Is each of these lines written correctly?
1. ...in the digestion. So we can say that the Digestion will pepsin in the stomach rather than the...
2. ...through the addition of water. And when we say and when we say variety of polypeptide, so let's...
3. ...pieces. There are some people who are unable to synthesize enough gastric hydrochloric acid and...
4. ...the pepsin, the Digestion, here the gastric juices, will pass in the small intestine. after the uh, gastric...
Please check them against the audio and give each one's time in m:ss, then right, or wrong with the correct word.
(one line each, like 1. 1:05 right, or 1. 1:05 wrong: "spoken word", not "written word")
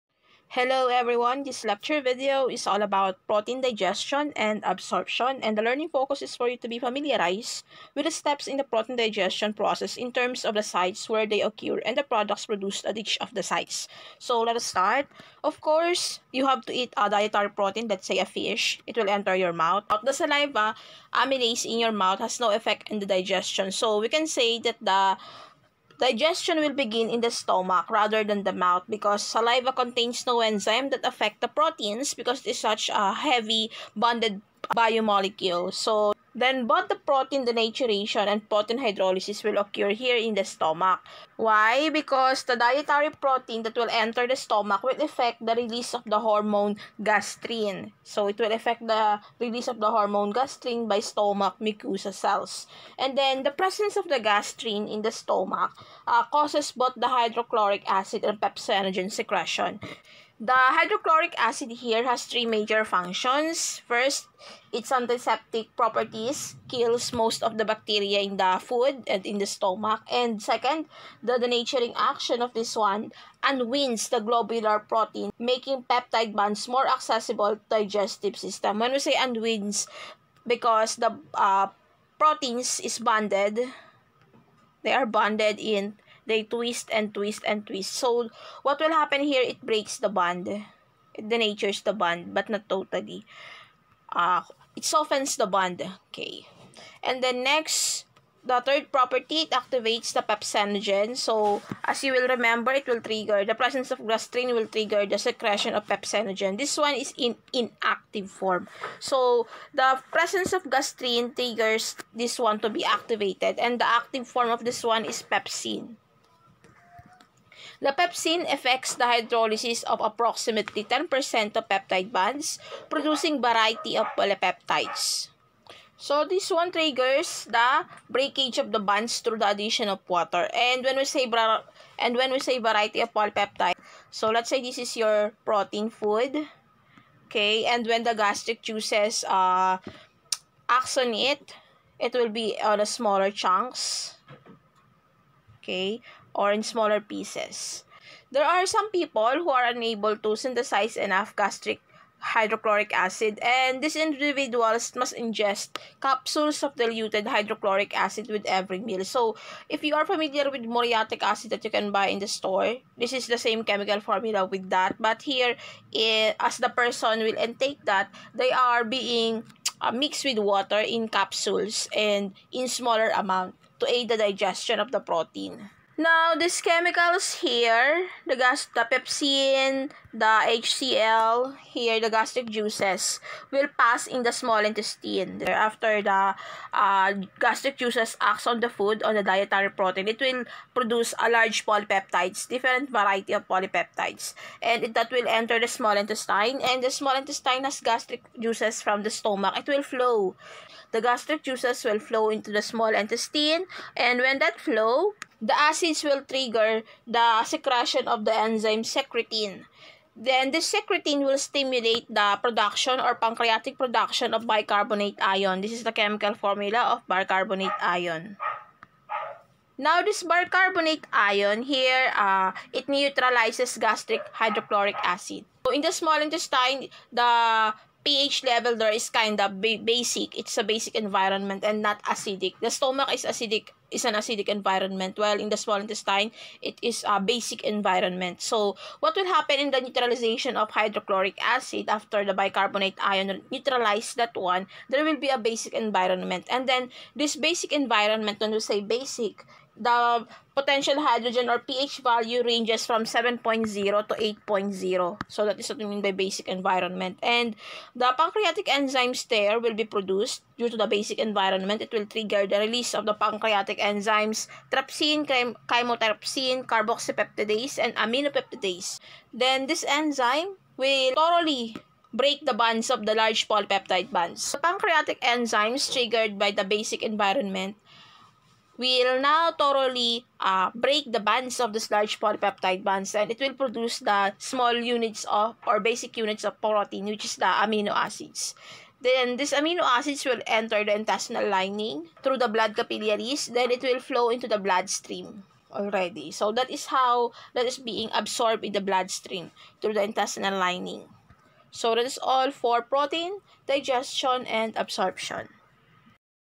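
1. 0:22 wrong: "begin", not "pepsin"
2. 2:09 right
3. 2:26 right
4. 2:58 wrong: "HCl", not "Digestion".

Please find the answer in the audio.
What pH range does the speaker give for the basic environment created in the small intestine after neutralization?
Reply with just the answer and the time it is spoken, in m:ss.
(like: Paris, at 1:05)
7.0 to 8.0, at 4:13.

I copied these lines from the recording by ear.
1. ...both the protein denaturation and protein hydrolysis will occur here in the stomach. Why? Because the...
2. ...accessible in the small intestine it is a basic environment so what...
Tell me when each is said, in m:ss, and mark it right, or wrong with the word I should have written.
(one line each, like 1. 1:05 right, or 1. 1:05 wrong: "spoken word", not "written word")
1. 0:36 right
2. 3:55 wrong: "while", not "accessible".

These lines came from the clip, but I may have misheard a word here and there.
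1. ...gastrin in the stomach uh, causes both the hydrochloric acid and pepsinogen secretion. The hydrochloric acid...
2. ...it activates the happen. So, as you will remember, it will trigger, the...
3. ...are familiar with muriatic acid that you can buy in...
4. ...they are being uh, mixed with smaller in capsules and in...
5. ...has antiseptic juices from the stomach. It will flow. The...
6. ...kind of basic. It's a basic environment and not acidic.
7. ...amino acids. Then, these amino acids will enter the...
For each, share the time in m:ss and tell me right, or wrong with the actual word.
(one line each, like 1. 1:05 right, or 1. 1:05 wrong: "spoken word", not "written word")
1. 0:54 right
2. 1:39 wrong: "pepsinogen", not "happen"
3. 2:39 right
4. 2:48 wrong: "water", not "smaller"
5. 3:17 wrong: "gastric", not "antiseptic"
6. 3:49 right
7. 4:47 right.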